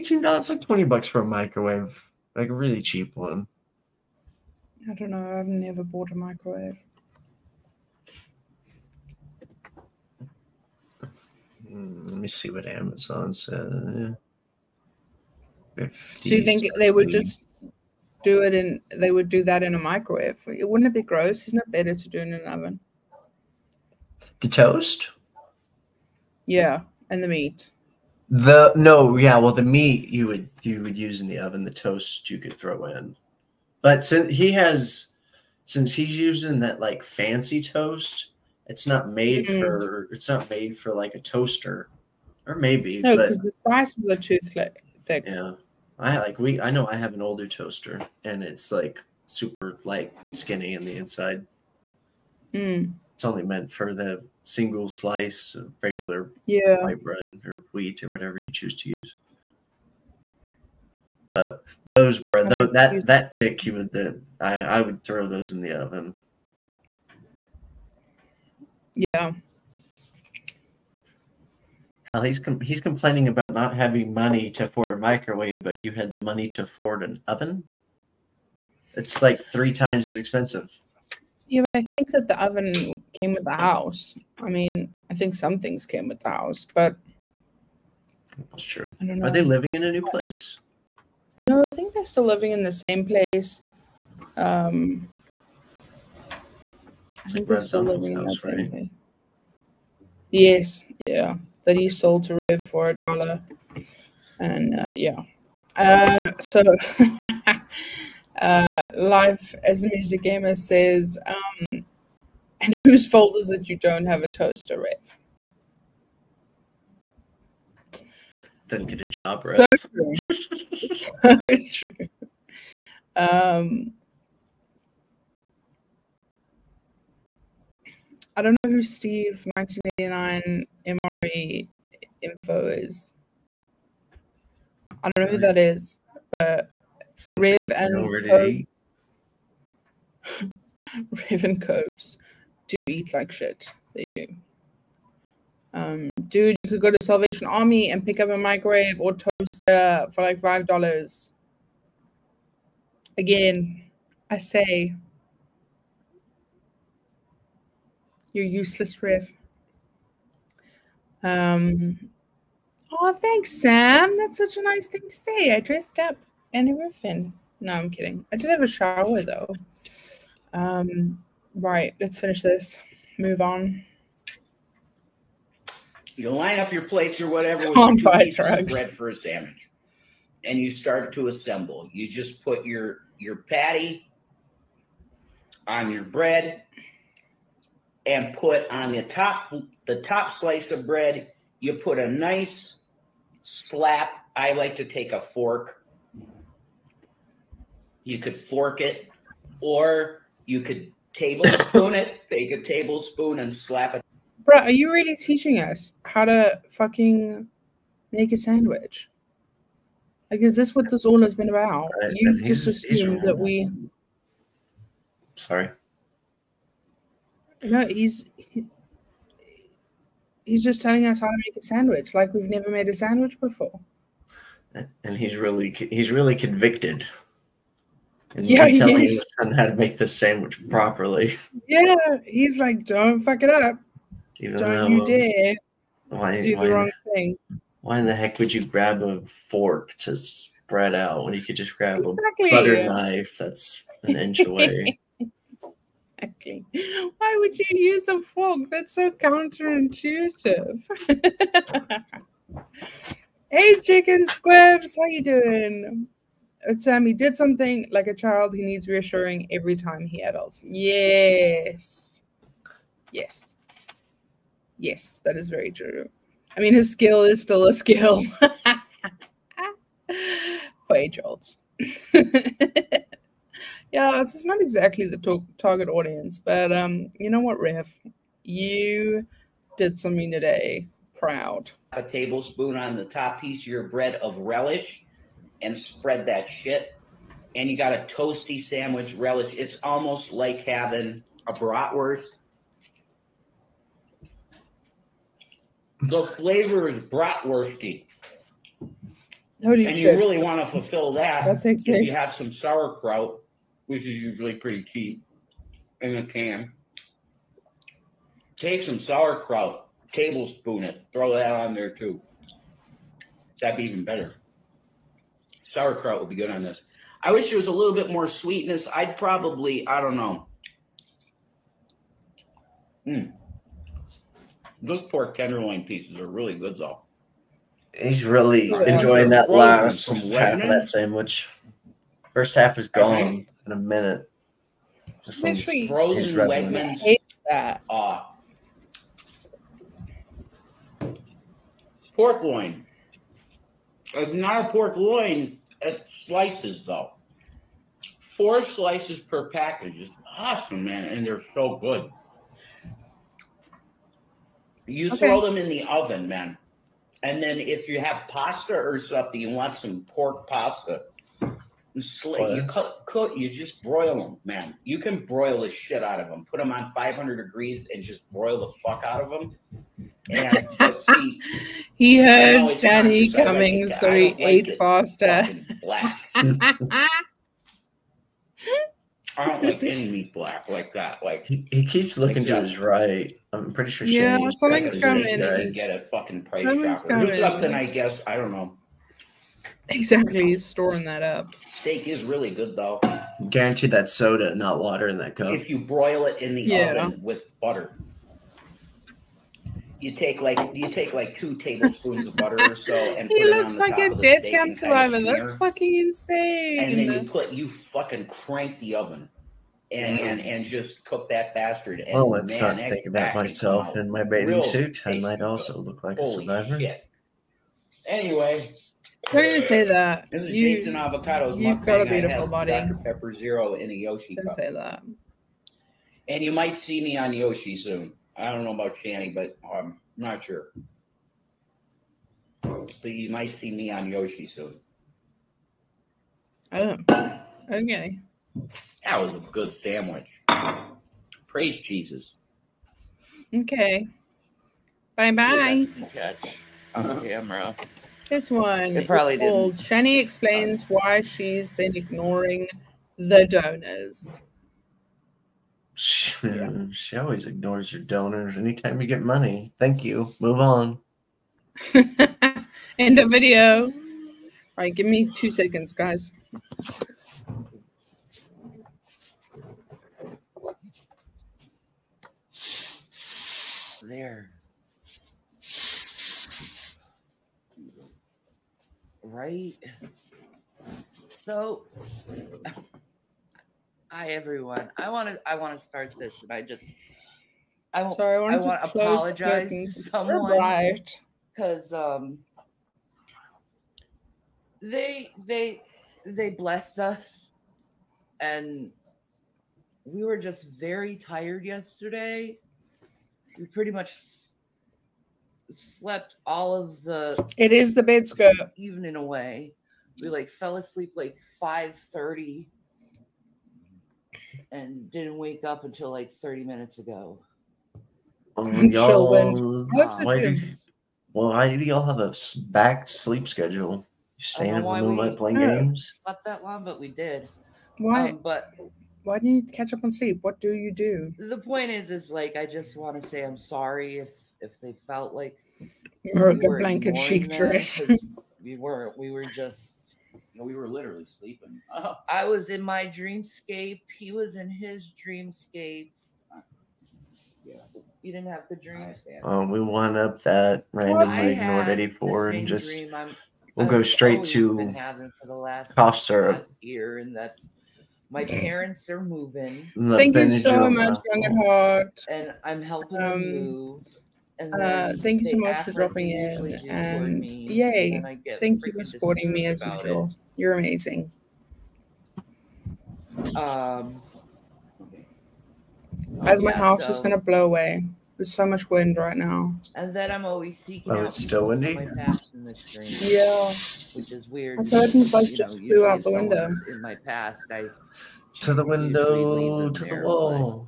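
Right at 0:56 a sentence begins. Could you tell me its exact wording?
white bread or wheat or whatever you choose to use.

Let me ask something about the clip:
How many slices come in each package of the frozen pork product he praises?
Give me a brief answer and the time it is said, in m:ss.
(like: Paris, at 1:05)
4, at 5:48.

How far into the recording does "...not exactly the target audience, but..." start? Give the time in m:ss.
4:34.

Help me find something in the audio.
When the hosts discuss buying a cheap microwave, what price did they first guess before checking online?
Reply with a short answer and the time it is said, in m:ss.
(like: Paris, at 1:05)
$20, at 0:00.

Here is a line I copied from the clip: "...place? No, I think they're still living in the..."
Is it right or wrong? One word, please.
right.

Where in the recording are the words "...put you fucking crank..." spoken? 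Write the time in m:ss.
6:47.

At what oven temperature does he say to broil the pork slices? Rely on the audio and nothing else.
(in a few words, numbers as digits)
500 degrees.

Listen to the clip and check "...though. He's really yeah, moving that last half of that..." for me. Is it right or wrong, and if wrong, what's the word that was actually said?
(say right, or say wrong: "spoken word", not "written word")
wrong: "enjoying", not "moving".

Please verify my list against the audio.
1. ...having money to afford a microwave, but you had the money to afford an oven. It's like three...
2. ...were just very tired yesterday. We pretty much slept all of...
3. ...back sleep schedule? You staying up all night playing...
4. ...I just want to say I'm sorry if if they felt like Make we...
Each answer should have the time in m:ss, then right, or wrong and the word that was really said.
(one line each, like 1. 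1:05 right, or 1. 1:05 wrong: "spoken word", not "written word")
1. 1:13 right
2. 8:20 right
3. 8:42 right
4. 8:52 wrong: "America", not "Make".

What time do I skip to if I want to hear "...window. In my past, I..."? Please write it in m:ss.
9:46.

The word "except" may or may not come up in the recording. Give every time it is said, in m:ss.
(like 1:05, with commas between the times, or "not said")
not said.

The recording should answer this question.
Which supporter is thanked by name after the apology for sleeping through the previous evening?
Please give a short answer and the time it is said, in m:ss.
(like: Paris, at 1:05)
Young at Heart, at 9:21.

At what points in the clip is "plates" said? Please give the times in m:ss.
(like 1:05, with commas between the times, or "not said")
2:56.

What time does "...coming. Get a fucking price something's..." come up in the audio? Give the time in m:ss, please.
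6:25.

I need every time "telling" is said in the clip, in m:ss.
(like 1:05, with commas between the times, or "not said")
3:40, 3:48.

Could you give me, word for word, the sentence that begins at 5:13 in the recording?
That'd be even better sauerkraut would be good on this.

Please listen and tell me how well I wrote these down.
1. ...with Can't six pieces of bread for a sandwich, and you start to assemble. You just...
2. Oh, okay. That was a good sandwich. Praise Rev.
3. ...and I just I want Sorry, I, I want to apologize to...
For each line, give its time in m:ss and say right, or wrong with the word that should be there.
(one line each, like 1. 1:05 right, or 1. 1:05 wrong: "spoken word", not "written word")
1. 2:57 wrong: "two", not "six"
2. 7:16 wrong: "Jesus", not "Rev"
3. 8:06 right.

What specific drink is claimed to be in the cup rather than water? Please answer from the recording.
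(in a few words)
Dr. Pepper Zero.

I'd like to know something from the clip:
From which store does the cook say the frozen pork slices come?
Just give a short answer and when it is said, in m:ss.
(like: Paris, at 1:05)
Wegmans, at 5:36.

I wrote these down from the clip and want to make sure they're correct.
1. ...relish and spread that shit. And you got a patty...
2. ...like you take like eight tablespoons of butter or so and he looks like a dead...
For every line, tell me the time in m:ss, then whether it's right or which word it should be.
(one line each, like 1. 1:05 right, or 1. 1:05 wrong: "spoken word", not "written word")
1. 4:44 wrong: "toasty", not "patty"
2. 6:40 wrong: "two", not "eight".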